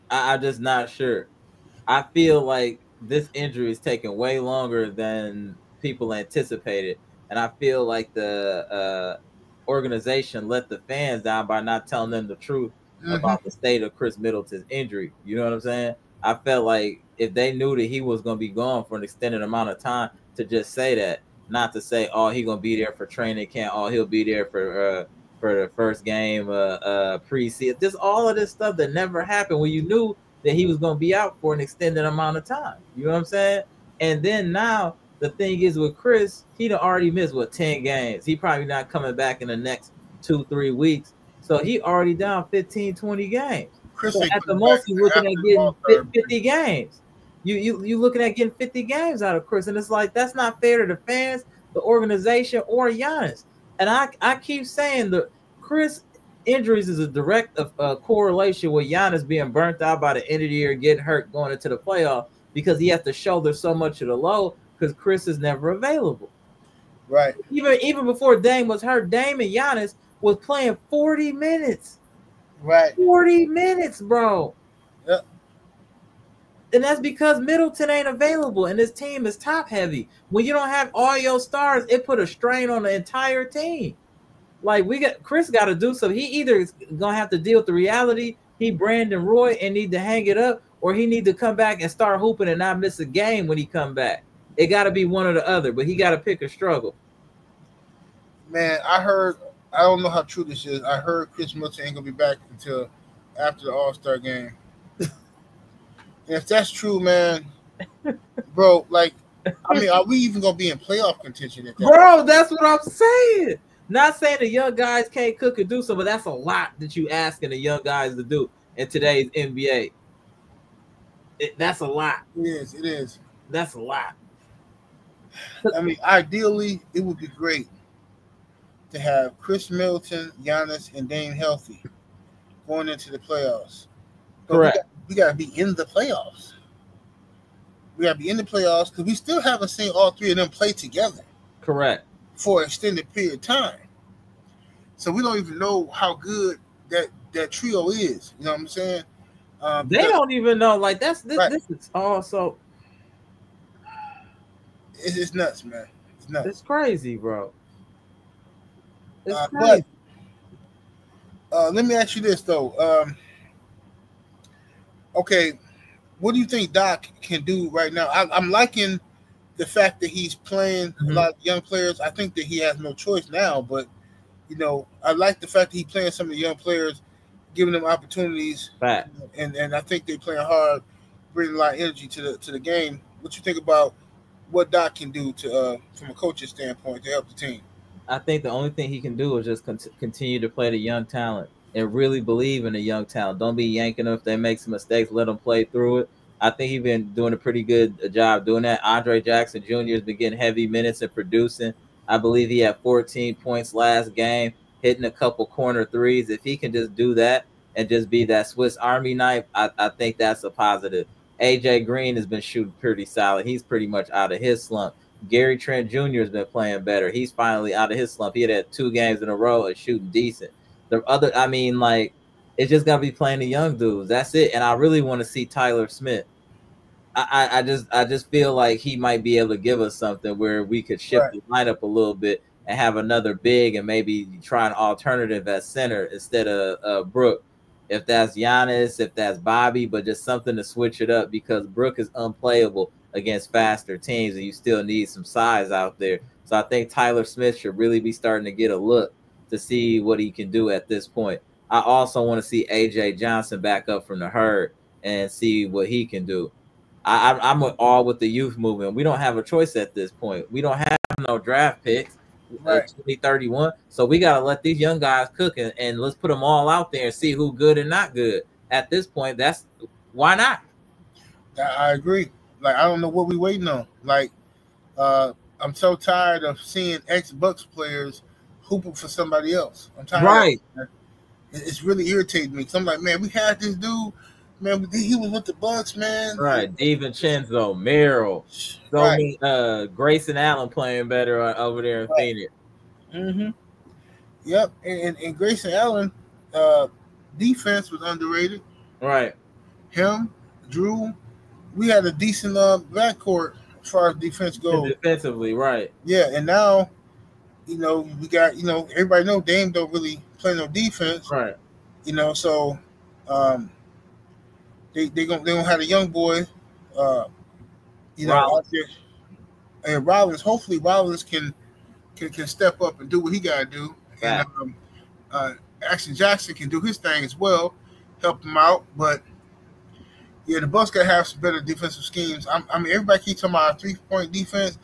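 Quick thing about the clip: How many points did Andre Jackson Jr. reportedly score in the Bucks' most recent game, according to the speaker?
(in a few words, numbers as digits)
14.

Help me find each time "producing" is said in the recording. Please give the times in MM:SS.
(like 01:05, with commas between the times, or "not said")
03:21.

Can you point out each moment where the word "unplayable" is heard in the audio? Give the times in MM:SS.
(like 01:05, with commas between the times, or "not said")
04:02.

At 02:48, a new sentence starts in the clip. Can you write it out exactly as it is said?
I, am liking the fact that he's playing mm-hmm.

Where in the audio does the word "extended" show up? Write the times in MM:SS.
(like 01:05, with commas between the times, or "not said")
00:19, 00:31, 02:22.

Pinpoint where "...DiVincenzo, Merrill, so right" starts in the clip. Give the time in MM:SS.
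04:46.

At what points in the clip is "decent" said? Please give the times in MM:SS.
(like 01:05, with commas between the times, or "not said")
03:40, 05:02.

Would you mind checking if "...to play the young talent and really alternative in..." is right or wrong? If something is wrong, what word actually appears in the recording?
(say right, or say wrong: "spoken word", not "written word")
wrong: "believe", not "alternative".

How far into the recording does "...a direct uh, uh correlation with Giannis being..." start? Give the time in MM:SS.
00:56.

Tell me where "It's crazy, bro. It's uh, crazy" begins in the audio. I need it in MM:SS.
02:36.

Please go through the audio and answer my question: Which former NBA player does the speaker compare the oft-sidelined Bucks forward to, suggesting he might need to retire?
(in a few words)
Brandon Roy.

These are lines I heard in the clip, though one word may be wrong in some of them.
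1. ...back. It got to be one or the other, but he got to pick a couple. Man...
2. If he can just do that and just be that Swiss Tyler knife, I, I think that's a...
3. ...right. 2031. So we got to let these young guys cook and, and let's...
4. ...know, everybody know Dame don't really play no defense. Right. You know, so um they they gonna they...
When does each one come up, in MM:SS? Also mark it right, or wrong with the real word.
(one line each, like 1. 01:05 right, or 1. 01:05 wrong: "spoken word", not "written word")
1. 01:33 wrong: "struggle", not "couple"
2. 03:26 wrong: "Army", not "Tyler"
3. 04:22 right
4. 05:08 right.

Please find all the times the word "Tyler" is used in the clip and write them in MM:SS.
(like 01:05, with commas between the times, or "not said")
03:45, 04:06.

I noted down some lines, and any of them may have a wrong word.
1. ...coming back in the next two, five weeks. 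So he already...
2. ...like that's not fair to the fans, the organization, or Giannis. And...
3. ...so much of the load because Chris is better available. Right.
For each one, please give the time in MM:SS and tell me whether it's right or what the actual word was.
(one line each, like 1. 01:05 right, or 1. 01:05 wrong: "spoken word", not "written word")
1. 00:38 wrong: "three", not "five"
2. 00:49 right
3. 01:03 wrong: "never", not "better".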